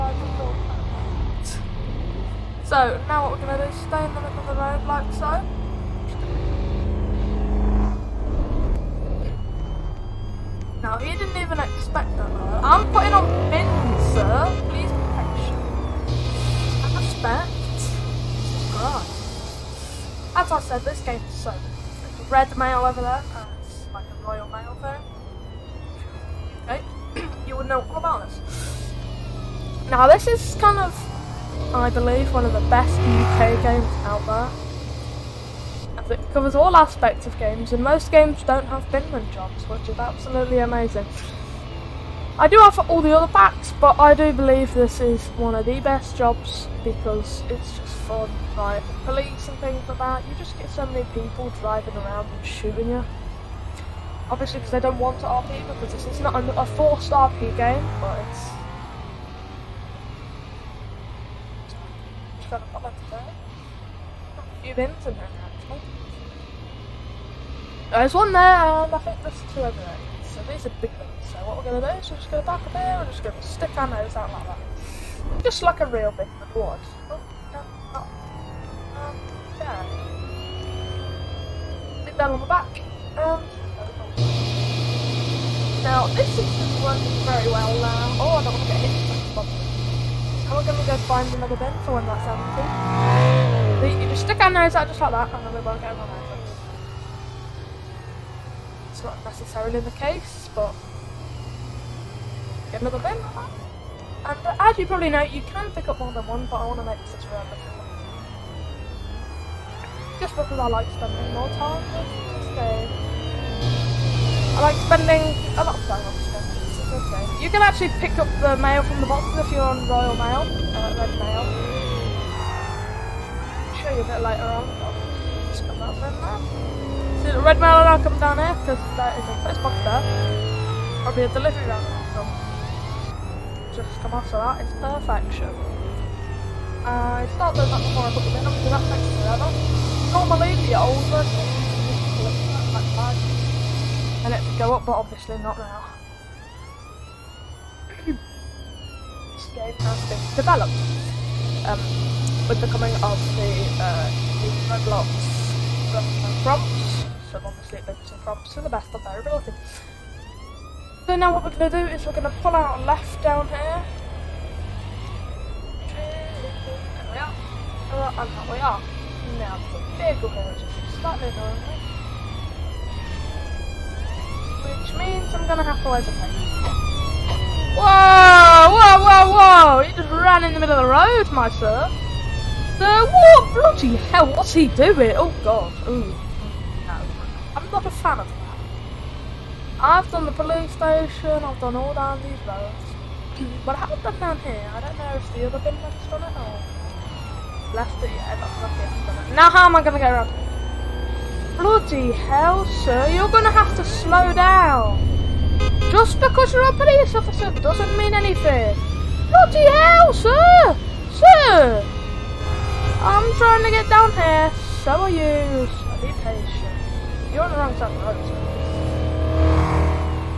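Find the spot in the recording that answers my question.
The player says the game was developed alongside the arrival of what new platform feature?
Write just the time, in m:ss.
2:34.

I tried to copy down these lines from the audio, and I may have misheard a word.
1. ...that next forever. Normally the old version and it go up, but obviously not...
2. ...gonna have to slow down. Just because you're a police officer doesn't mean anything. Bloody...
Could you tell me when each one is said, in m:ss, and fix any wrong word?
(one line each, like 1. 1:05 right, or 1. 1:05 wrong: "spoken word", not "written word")
1. 2:18 right
2. 3:23 right.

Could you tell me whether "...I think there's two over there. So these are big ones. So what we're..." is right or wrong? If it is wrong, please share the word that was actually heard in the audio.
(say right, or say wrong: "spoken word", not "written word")
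right.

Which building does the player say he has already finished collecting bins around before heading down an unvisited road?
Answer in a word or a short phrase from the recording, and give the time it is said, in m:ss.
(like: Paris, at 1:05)
The police station, at 3:10.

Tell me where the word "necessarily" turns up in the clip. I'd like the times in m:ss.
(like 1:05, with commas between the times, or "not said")
1:39.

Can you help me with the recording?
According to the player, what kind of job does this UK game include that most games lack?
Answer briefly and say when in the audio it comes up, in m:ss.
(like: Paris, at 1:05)
Binman jobs, at 0:38.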